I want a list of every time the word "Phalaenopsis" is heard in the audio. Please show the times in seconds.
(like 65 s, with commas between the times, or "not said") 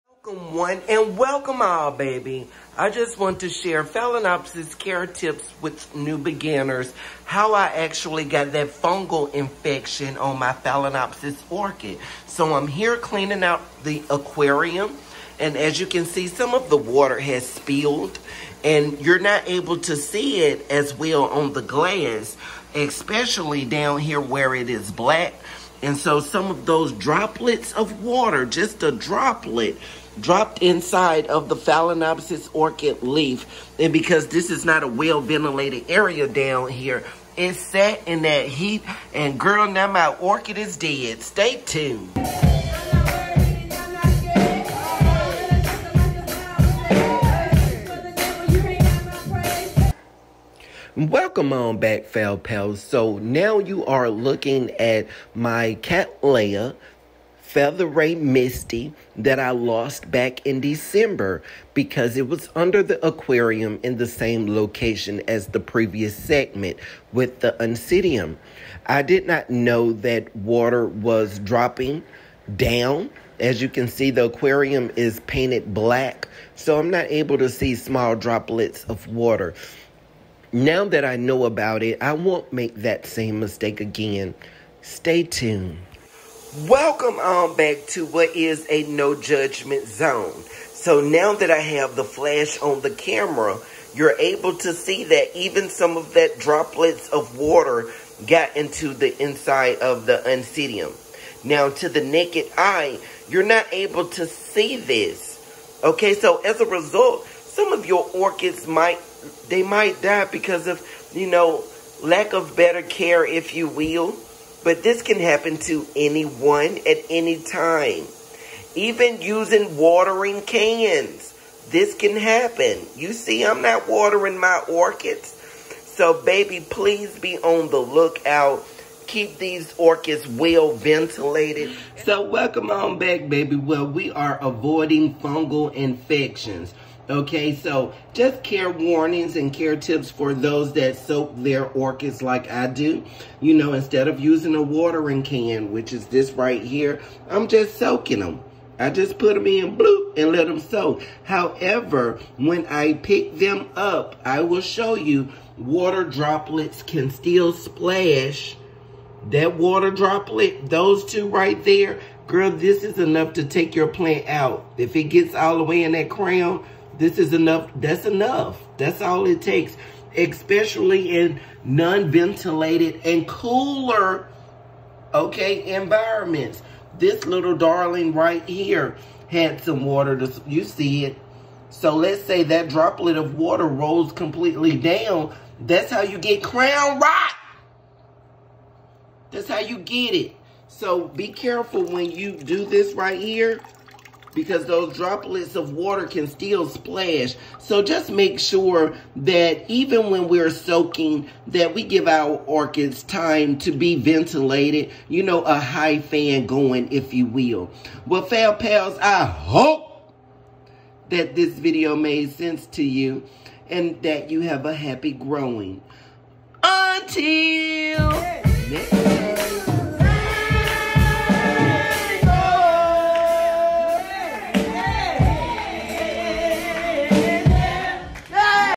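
3 s, 10 s, 31 s.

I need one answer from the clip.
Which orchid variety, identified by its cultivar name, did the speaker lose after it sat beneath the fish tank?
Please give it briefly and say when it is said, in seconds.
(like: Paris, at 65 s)
Cattleya Ray Misty, at 55 s.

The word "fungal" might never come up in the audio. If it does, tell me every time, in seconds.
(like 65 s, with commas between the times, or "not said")
8 s, 135 s.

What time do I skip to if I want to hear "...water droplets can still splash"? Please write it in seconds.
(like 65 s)
155 s.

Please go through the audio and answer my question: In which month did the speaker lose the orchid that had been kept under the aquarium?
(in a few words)
December.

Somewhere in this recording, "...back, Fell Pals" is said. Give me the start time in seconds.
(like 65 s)
51 s.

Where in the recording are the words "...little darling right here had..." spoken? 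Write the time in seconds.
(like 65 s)
177 s.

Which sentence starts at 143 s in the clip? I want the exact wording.
You know, instead of using a watering can, which is this right here, I'm just soaking them.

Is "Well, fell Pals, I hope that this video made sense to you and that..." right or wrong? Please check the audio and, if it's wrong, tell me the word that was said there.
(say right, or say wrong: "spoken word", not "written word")
right.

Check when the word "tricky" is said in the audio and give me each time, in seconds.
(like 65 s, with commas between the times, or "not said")
not said.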